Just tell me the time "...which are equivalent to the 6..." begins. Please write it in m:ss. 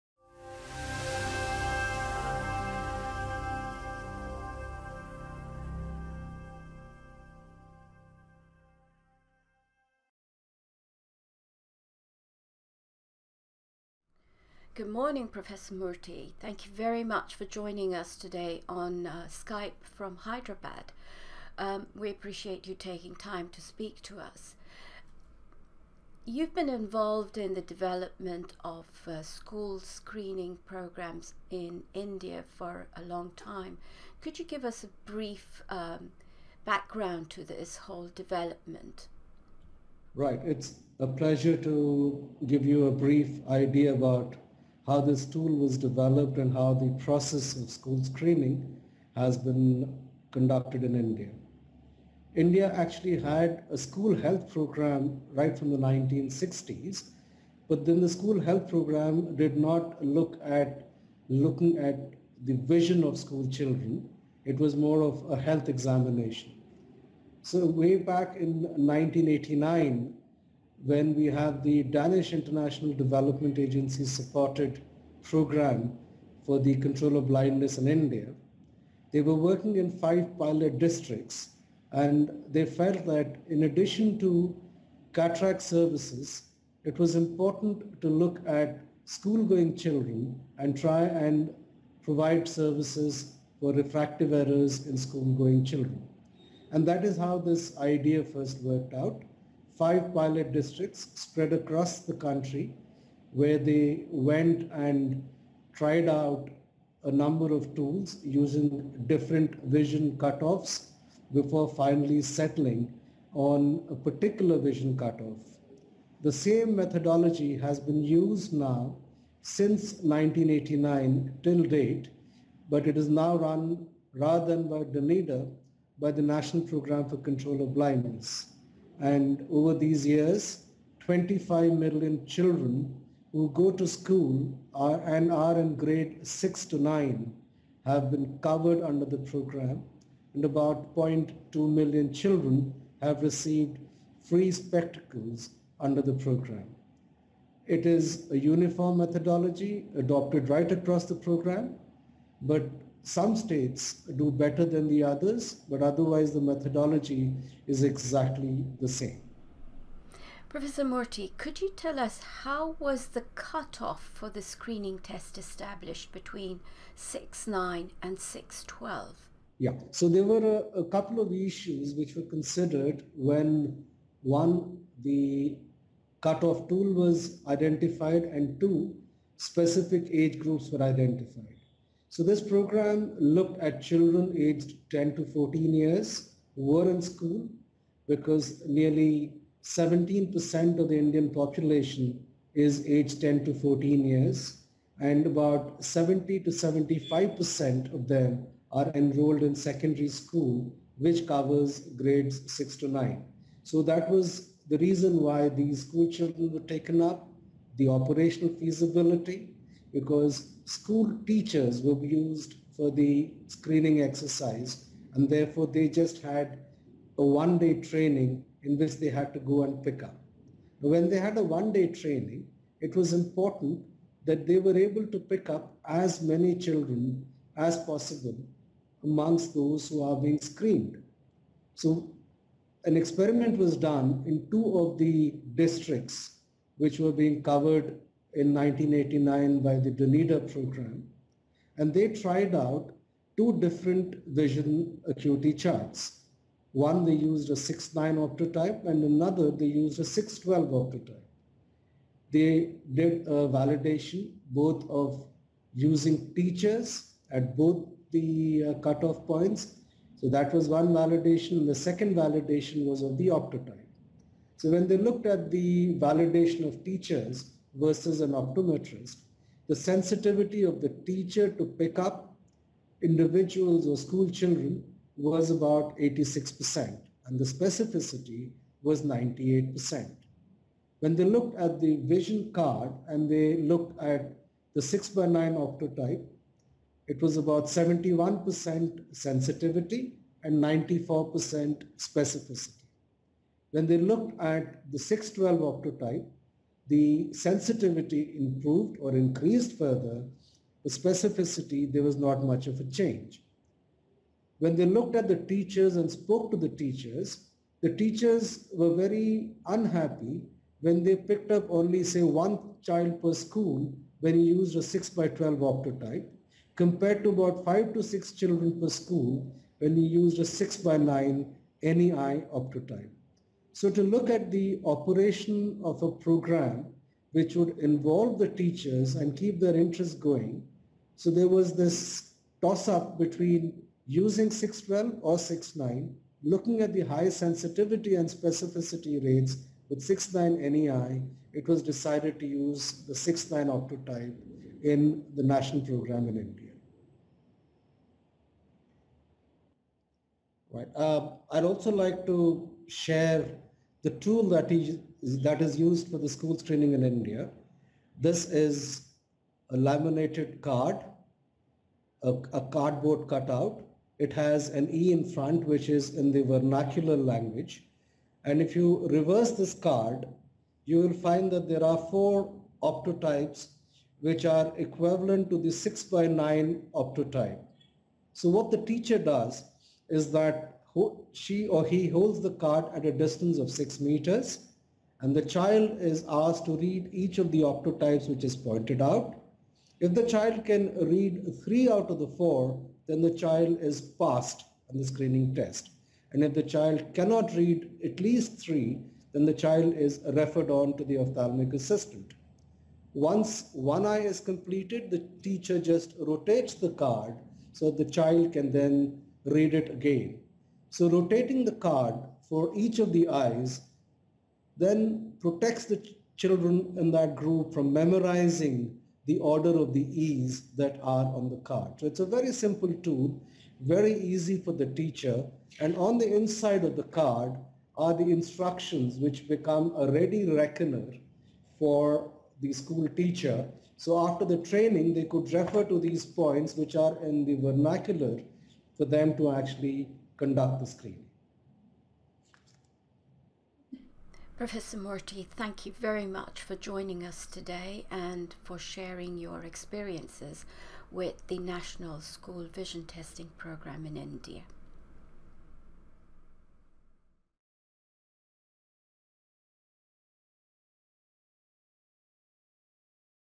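6:14.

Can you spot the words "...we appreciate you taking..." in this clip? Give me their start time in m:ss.
0:21.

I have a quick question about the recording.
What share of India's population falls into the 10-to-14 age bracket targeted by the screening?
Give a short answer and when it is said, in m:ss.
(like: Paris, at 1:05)
17%, at 3:09.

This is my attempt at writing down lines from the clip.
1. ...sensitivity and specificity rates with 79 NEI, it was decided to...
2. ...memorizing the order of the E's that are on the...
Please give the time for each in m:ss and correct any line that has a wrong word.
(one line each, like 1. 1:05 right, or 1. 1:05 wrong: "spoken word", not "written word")
1. 5:37 wrong: "69", not "79"
2. 6:57 right.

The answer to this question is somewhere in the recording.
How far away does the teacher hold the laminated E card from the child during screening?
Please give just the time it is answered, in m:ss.
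6:23.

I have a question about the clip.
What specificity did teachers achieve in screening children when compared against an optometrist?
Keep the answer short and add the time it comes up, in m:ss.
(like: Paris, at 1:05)
98%, at 4:39.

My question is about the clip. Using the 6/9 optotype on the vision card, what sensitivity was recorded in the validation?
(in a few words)
71%.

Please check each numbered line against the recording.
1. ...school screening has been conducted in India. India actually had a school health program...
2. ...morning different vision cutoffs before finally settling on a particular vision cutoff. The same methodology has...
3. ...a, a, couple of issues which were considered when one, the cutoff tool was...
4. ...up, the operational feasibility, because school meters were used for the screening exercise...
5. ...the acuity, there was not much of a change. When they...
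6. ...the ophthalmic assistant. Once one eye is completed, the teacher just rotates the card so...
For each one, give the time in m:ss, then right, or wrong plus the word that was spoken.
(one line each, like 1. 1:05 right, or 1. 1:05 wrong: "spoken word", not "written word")
1. 0:47 right
2. 1:48 wrong: "using", not "morning"
3. 2:50 right
4. 3:27 wrong: "teachers", not "meters"
5. 5:00 wrong: "specificity", not "acuity"
6. 6:41 right.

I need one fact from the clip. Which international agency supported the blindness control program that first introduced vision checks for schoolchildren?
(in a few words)
Danish International Development Agency.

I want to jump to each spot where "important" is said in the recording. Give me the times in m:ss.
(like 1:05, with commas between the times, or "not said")
1:27, 3:43.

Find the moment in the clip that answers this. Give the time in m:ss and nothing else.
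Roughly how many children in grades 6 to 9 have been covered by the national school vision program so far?
2:10.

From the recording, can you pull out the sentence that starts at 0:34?
Could you give us a brief um, background to this whole development?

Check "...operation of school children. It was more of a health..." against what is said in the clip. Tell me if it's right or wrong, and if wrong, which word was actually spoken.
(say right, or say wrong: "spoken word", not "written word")
wrong: "vision", not "operation".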